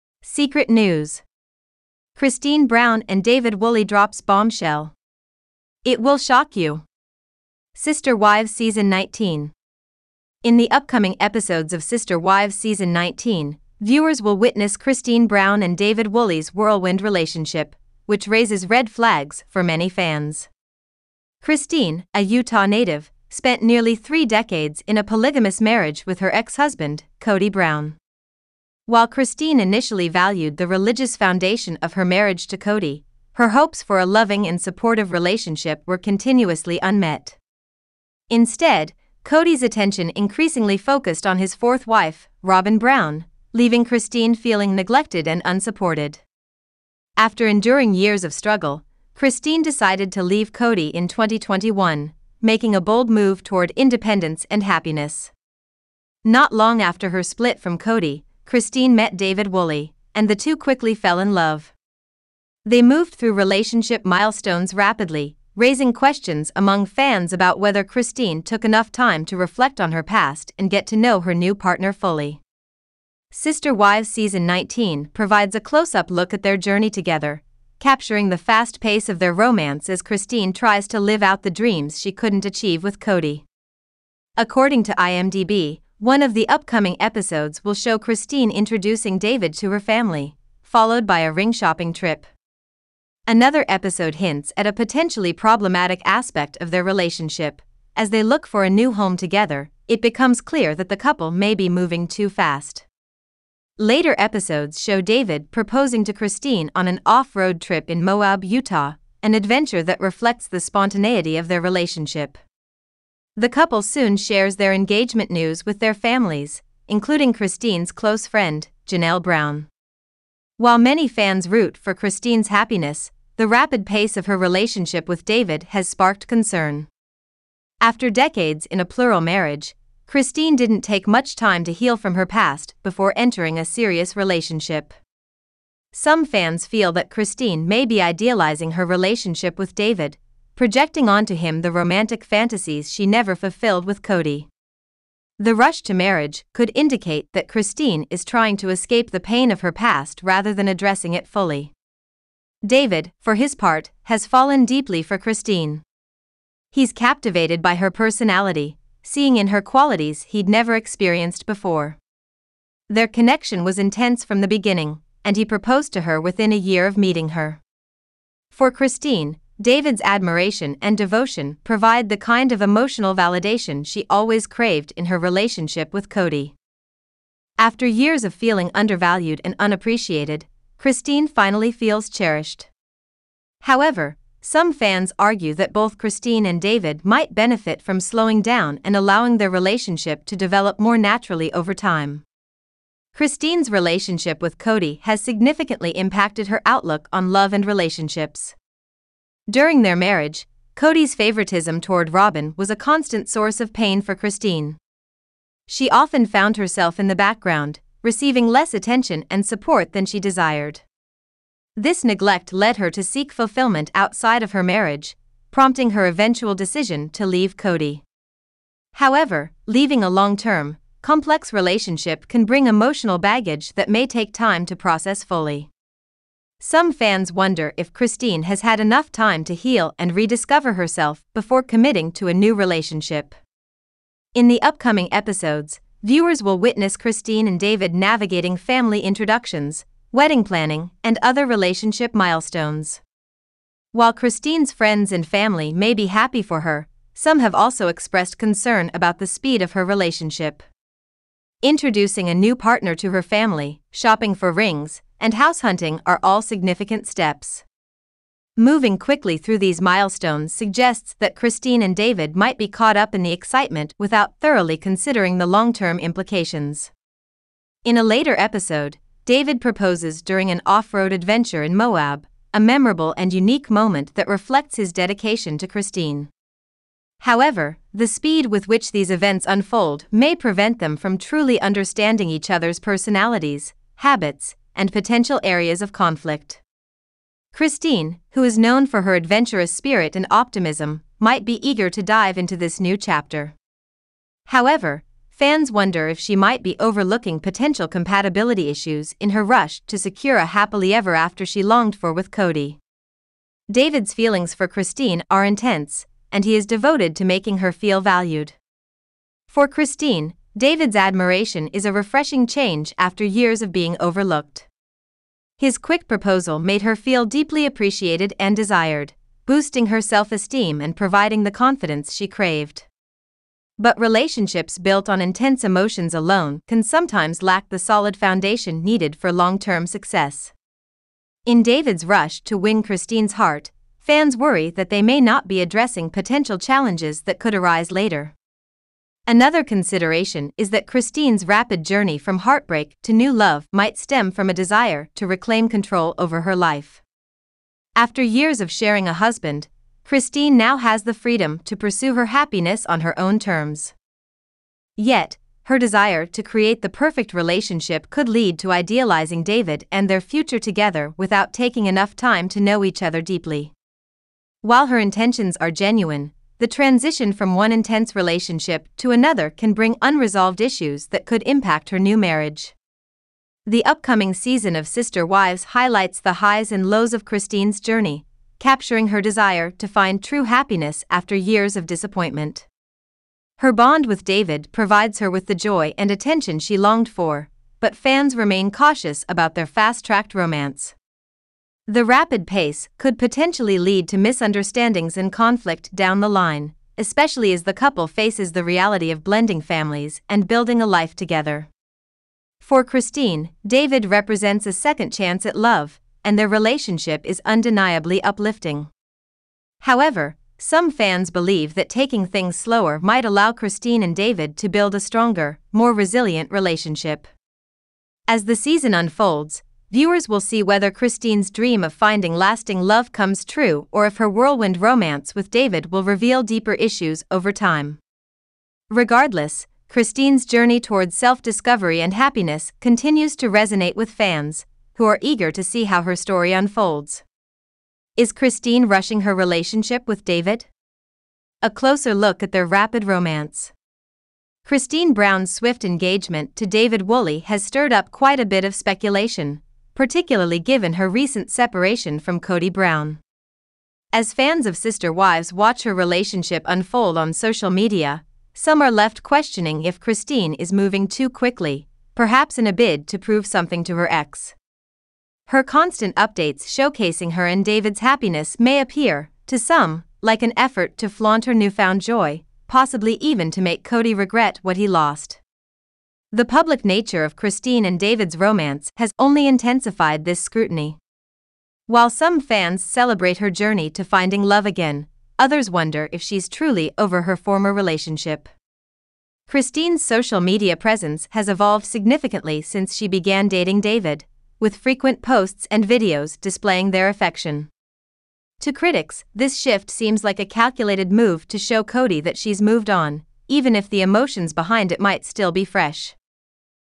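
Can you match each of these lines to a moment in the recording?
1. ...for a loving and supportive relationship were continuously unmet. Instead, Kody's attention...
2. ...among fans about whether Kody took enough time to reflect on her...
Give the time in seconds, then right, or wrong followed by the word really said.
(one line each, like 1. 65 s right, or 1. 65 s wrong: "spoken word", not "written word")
1. 33 s right
2. 66 s wrong: "Christine", not "Kody".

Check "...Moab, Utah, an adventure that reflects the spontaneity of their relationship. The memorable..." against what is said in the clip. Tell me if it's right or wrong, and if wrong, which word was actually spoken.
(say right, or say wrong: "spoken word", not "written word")
wrong: "couple", not "memorable".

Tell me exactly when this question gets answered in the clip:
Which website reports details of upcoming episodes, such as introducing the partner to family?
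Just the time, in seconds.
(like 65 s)
84 s.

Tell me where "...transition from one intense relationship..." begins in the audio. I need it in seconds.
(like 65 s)
366 s.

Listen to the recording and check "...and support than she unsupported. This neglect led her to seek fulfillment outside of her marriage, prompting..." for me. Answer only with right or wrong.
wrong.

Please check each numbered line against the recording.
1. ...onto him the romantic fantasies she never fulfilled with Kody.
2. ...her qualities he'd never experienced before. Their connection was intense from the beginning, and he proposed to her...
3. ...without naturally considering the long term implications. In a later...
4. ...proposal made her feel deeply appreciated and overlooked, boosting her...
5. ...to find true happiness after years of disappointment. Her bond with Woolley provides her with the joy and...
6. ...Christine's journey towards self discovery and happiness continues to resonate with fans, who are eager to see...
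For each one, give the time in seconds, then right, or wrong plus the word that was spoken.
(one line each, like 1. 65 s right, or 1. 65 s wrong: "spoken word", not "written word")
1. 141 s right
2. 159 s right
3. 263 s wrong: "thoroughly", not "naturally"
4. 316 s wrong: "desired", not "overlooked"
5. 379 s wrong: "David", not "Woolley"
6. 429 s right.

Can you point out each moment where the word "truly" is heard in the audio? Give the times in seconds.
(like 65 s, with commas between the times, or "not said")
281 s, 486 s.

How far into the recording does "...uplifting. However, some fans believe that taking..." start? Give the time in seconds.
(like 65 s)
408 s.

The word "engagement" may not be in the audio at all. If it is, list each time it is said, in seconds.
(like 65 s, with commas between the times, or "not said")
114 s, 445 s.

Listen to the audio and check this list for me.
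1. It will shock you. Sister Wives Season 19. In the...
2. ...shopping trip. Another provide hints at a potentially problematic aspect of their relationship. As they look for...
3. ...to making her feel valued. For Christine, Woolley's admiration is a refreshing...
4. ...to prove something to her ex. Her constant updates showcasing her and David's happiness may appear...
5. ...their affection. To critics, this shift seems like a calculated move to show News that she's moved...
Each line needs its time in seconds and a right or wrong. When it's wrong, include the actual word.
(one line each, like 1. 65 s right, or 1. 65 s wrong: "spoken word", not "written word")
1. 5 s right
2. 91 s wrong: "episode", not "provide"
3. 307 s wrong: "David", not "Woolley"
4. 463 s right
5. 496 s wrong: "Kody", not "News".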